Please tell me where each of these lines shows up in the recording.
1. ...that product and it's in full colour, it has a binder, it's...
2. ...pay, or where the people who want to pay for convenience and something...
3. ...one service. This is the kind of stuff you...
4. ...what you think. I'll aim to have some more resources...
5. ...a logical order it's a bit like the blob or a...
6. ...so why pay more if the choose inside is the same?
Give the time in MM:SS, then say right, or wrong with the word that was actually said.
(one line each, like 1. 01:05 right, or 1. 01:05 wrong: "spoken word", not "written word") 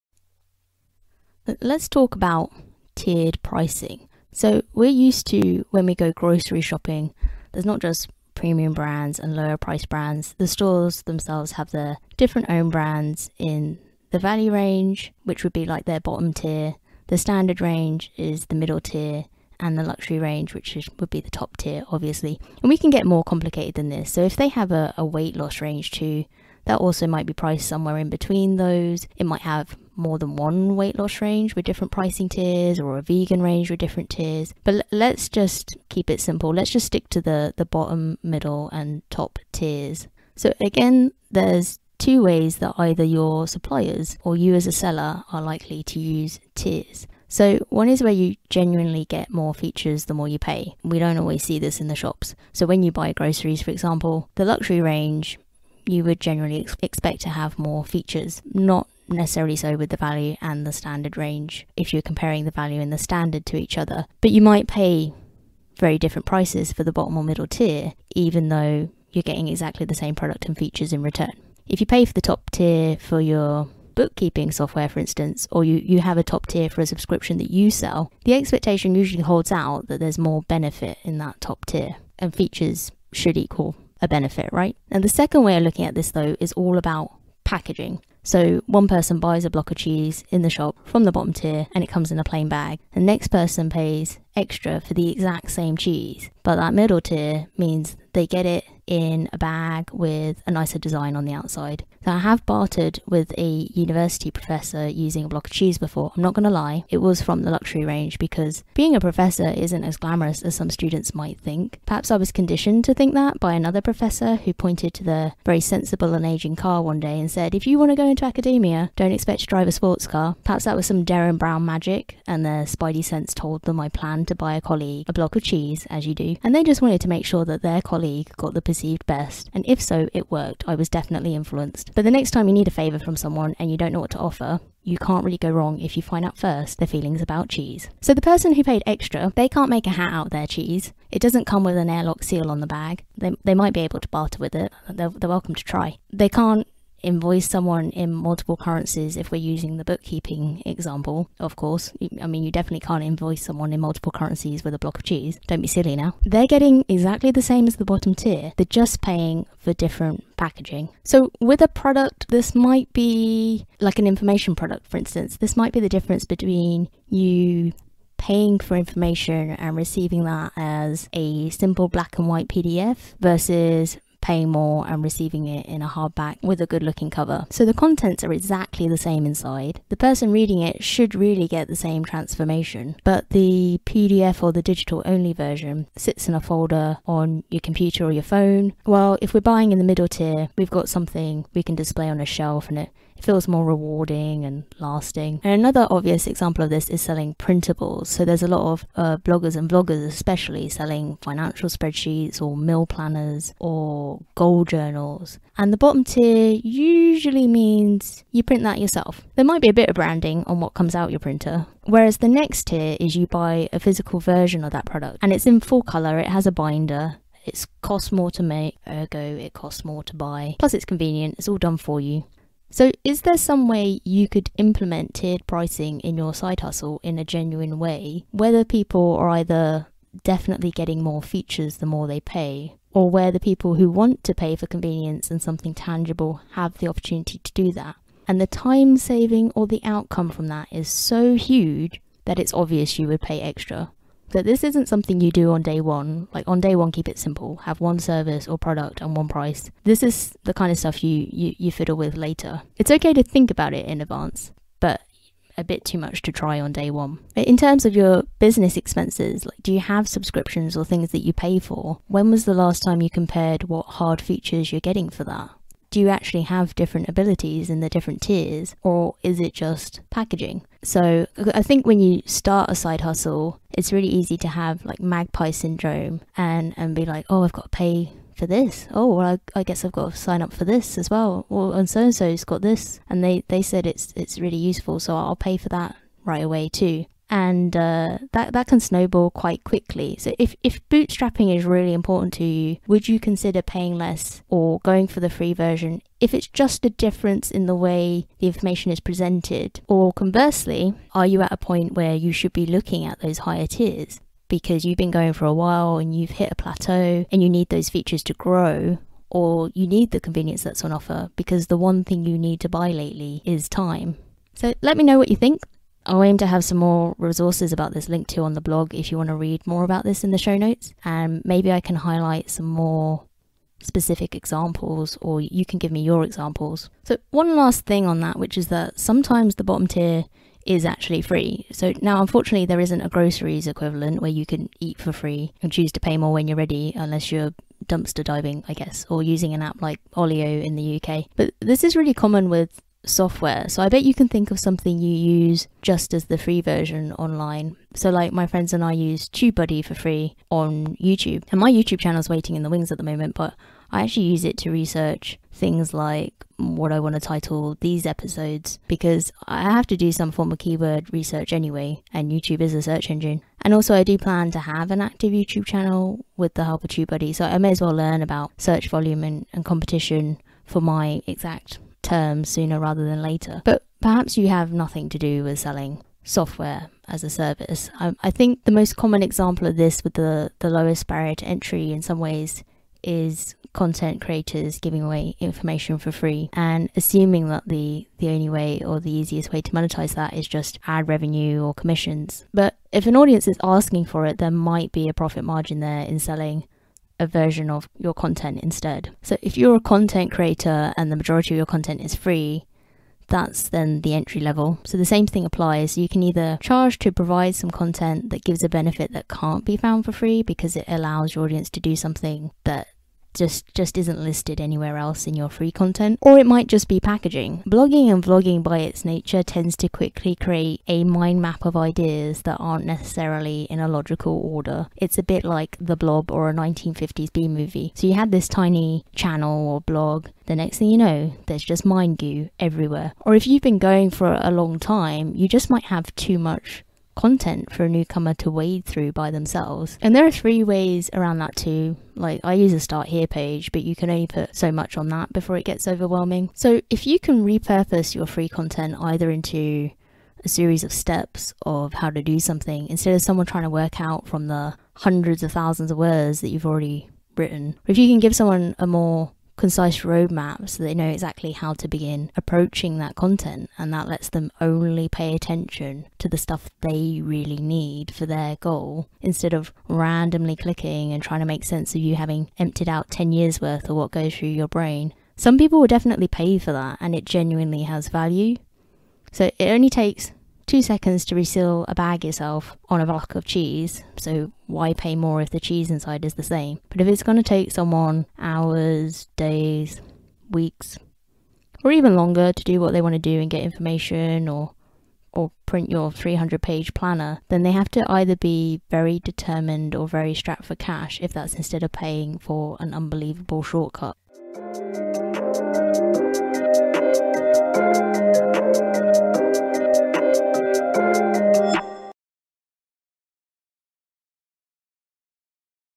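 1. 03:34 right
2. 03:52 right
3. 04:09 wrong: "price", not "service"
4. 05:15 right
5. 07:03 right
6. 08:04 wrong: "cheese", not "choose".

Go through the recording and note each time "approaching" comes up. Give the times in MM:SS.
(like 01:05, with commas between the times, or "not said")
07:42.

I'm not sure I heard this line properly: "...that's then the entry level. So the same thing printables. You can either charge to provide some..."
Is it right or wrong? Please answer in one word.
wrong.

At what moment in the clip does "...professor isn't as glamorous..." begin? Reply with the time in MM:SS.
01:48.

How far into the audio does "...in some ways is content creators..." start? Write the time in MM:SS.
06:21.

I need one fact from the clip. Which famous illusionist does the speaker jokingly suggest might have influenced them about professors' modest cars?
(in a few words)
Derren Brown.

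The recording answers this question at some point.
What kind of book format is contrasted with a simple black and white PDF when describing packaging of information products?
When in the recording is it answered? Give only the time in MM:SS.
02:55.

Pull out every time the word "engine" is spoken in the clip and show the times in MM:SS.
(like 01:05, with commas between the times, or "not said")
06:03.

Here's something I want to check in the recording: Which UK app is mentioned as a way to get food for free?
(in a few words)
Olio.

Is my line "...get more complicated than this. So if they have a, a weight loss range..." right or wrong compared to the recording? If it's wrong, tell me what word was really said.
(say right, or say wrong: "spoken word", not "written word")
right.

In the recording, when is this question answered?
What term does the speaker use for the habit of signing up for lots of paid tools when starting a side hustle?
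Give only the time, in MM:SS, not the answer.
04:35.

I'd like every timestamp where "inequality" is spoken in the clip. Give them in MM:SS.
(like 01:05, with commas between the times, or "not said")
not said.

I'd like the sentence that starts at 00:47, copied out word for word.
So, one is where you genuinely get more features the more you pay.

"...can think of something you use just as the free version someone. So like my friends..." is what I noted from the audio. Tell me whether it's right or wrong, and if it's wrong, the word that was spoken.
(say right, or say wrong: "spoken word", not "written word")
wrong: "online", not "someone".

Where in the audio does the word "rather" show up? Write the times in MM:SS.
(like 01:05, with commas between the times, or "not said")
06:12.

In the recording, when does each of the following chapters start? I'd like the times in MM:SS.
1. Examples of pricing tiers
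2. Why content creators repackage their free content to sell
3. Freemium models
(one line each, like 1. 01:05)
1. 02:40
2. 06:30
3. 05:25.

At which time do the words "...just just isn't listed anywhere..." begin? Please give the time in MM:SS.
06:53.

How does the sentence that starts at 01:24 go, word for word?
And the second way of looking at this though is all about packaging.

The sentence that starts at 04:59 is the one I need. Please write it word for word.
Or conversely, are you at a point where you should be looking at those higher tiers?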